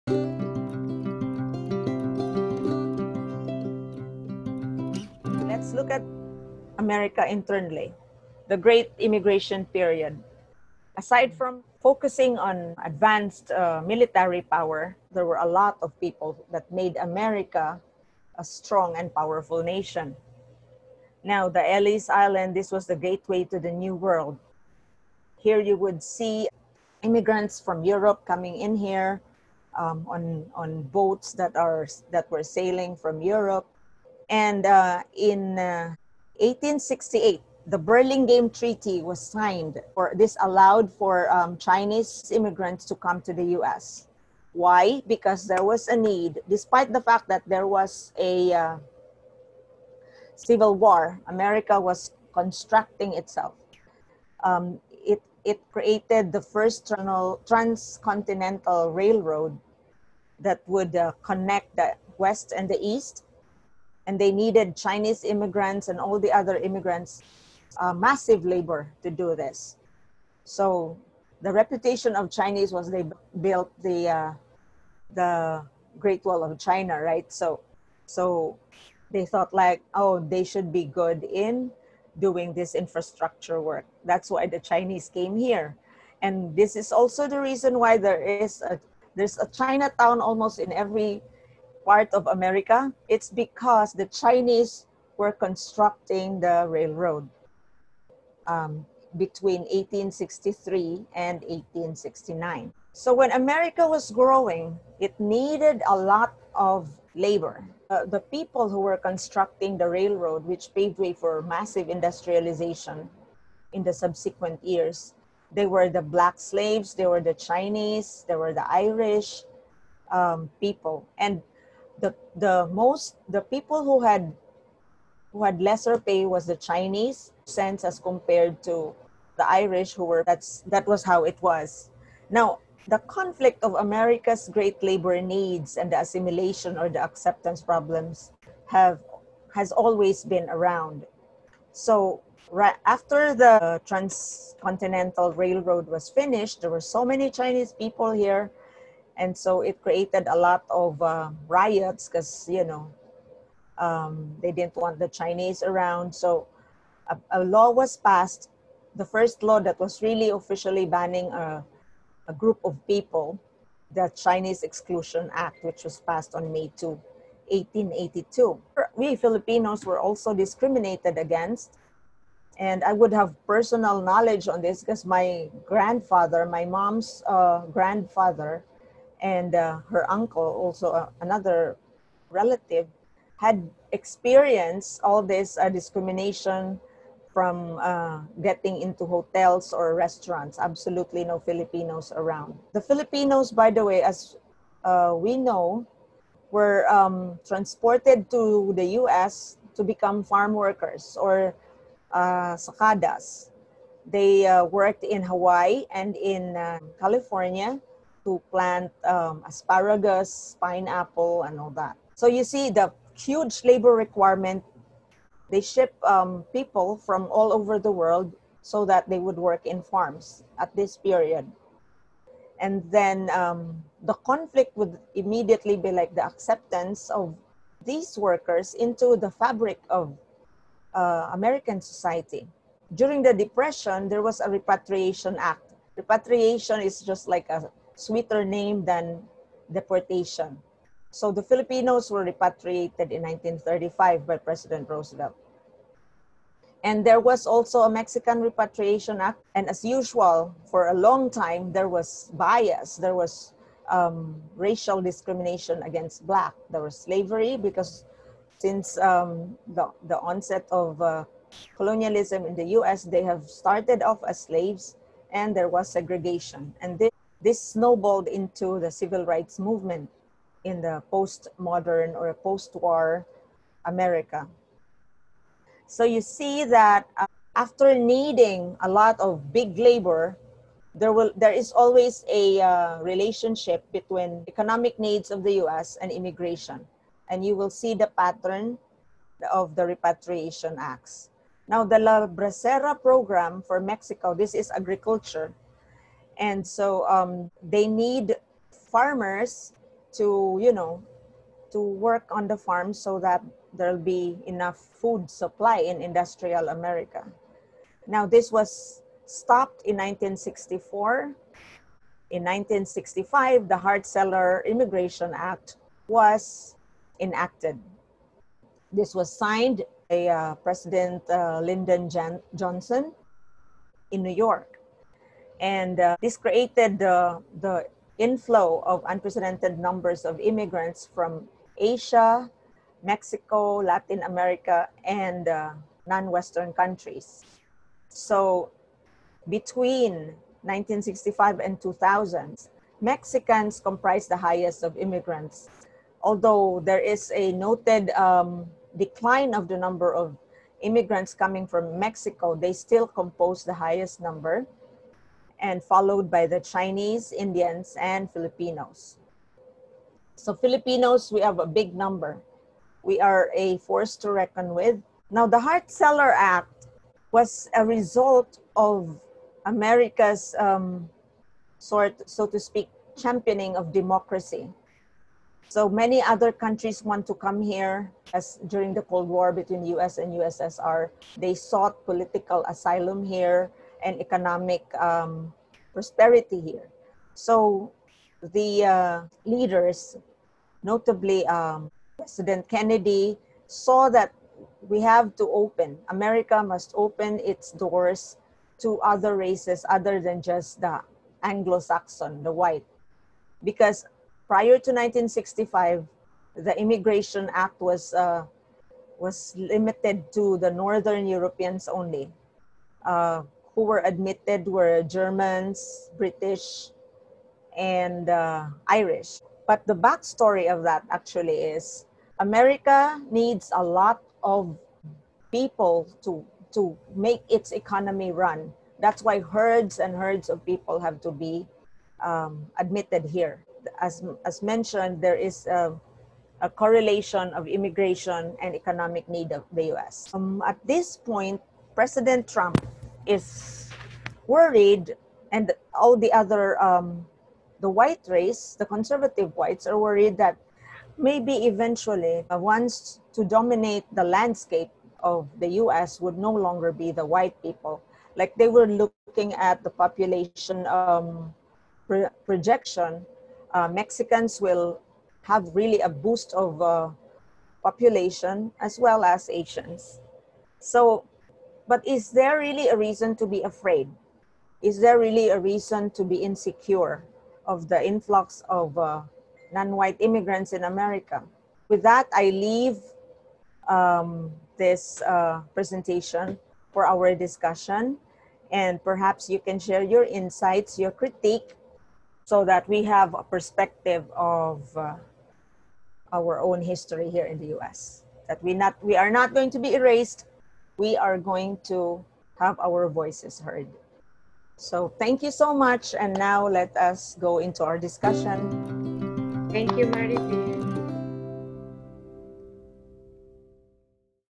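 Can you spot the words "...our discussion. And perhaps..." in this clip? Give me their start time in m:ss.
8:07.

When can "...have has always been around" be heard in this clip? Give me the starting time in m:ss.
2:18.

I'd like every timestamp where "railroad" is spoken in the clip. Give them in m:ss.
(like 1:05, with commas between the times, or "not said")
0:58, 1:36, 1:49, 2:25.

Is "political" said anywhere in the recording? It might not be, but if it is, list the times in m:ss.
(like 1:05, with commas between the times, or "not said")
6:22.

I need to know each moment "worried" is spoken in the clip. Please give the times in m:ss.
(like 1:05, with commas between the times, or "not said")
7:24, 7:29.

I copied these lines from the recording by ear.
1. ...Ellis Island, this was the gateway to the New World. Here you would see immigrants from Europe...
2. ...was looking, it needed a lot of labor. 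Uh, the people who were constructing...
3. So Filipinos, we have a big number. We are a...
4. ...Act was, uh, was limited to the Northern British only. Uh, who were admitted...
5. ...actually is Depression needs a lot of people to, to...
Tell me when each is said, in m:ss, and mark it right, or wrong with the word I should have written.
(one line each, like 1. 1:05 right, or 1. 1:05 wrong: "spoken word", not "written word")
1. 0:21 right
2. 1:43 wrong: "growing", not "looking"
3. 6:00 right
4. 6:47 wrong: "Europeans", not "British"
5. 7:01 wrong: "America", not "Depression".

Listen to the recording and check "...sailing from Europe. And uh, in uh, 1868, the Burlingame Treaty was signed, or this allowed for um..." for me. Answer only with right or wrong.
right.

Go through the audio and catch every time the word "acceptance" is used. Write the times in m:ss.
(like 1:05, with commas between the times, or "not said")
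2:17, 3:46.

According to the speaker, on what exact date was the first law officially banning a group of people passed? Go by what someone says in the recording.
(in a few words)
May 2, 1882.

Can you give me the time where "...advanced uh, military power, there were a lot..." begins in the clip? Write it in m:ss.
0:12.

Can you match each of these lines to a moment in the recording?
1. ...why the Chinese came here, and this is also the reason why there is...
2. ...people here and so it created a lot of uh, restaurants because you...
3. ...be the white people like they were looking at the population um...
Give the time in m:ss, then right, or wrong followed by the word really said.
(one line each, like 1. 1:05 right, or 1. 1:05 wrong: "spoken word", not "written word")
1. 1:24 right
2. 2:27 wrong: "riots", not "restaurants"
3. 7:36 right.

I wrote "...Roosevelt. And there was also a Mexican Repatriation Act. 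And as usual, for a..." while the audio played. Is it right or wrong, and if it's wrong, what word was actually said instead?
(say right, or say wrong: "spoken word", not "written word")
right.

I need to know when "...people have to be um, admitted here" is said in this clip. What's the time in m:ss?
7:10.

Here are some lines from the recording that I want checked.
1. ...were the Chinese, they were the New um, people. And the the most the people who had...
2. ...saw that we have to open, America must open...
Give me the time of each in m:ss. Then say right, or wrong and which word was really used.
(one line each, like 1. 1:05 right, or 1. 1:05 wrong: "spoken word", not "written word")
1. 1:57 wrong: "Irish", not "New"
2. 6:33 right.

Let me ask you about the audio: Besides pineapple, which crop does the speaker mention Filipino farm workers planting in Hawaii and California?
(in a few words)
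asparagus.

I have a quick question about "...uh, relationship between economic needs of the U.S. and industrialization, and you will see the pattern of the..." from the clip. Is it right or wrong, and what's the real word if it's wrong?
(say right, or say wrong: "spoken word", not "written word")
wrong: "immigration", not "industrialization".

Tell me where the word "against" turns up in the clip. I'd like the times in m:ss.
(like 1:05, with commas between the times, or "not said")
2:51, 4:15.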